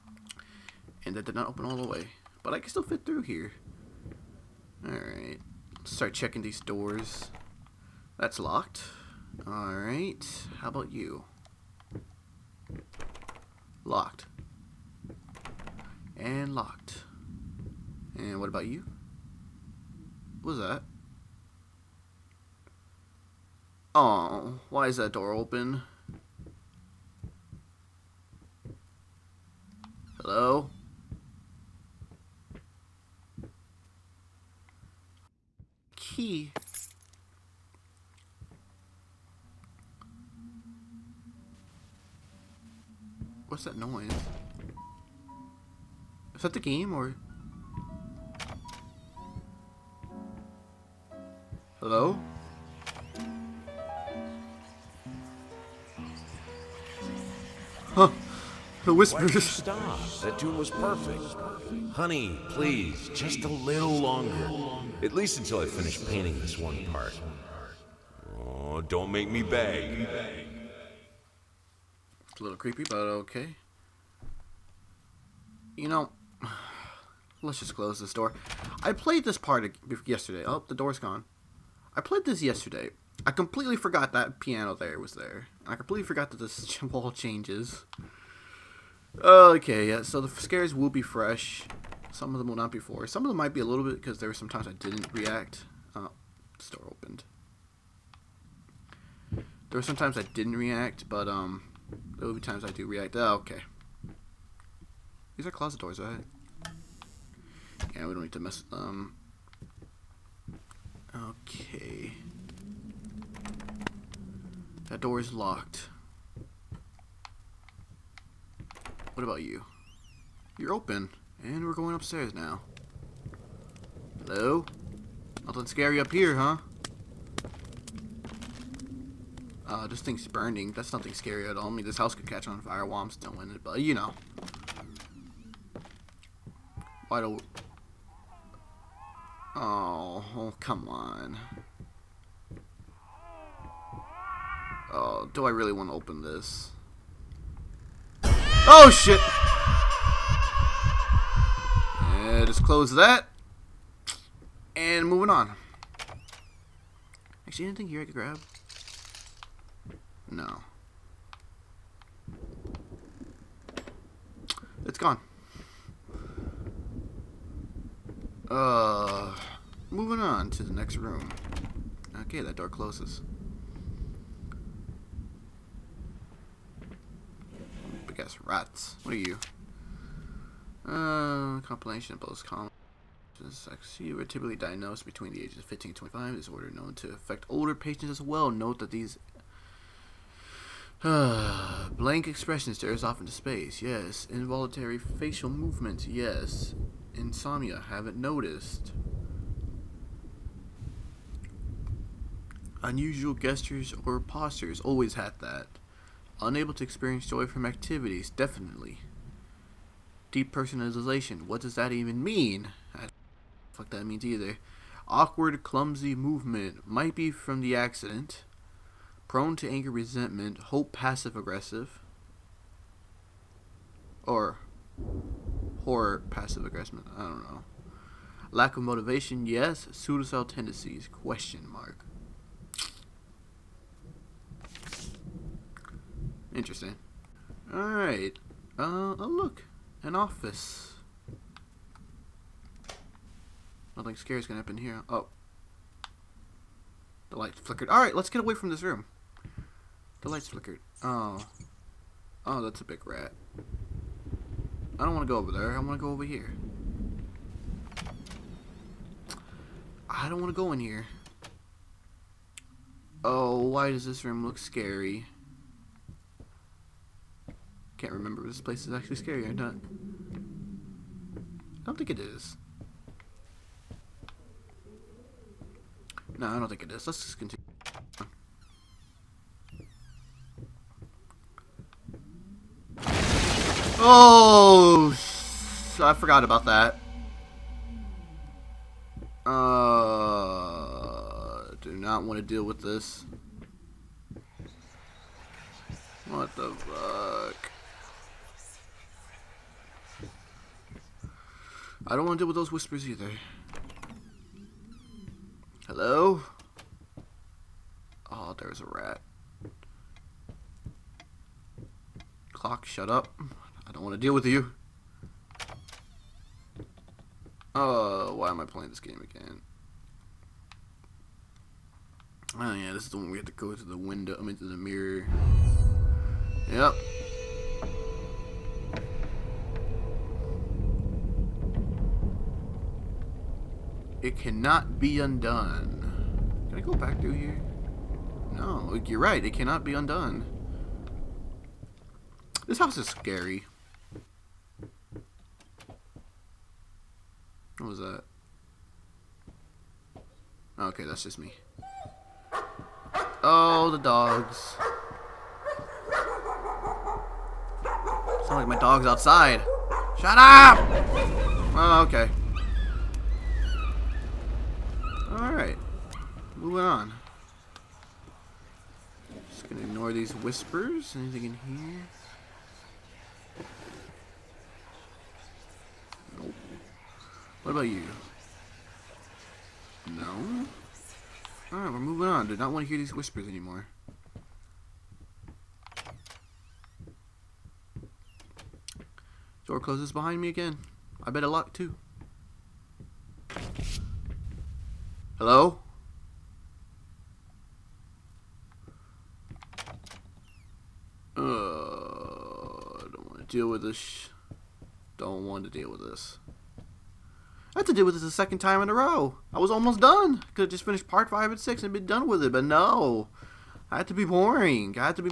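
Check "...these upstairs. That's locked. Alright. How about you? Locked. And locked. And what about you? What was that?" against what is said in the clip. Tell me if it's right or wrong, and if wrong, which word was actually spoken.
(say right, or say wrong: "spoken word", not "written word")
wrong: "doors", not "upstairs".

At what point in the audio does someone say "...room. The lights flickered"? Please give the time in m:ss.
4:08.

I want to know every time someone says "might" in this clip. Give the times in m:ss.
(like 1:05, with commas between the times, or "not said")
1:33, 3:36.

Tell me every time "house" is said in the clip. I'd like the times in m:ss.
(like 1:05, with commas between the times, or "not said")
2:11, 5:42.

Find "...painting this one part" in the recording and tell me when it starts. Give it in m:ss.
1:06.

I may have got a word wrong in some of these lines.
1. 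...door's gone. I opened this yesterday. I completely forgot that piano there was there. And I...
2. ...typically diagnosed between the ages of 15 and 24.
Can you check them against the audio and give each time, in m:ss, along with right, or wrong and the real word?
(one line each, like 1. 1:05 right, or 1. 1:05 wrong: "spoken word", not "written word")
1. 1:20 wrong: "played", not "opened"
2. 3:04 wrong: "25", not "24".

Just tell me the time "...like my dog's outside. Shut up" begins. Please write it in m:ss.
5:58.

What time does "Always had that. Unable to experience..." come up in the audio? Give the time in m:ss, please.
3:24.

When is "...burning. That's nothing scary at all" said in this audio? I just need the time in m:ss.
2:10.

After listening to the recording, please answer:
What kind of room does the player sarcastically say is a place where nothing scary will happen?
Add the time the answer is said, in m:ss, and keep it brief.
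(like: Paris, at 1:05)
An office, at 4:00.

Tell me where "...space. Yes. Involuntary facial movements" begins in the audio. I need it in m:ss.
3:13.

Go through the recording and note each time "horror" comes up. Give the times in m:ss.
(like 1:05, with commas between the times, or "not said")
3:45.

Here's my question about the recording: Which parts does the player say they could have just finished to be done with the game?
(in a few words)
5 and 6.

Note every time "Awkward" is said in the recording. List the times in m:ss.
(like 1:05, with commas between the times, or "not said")
3:35.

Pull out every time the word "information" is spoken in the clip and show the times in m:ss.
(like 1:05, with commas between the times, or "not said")
not said.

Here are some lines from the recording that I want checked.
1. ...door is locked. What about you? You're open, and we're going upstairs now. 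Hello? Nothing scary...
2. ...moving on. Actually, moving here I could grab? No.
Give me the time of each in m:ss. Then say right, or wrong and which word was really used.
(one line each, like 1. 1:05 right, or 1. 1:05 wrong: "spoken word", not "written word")
1. 1:55 right
2. 2:35 wrong: "anything", not "moving".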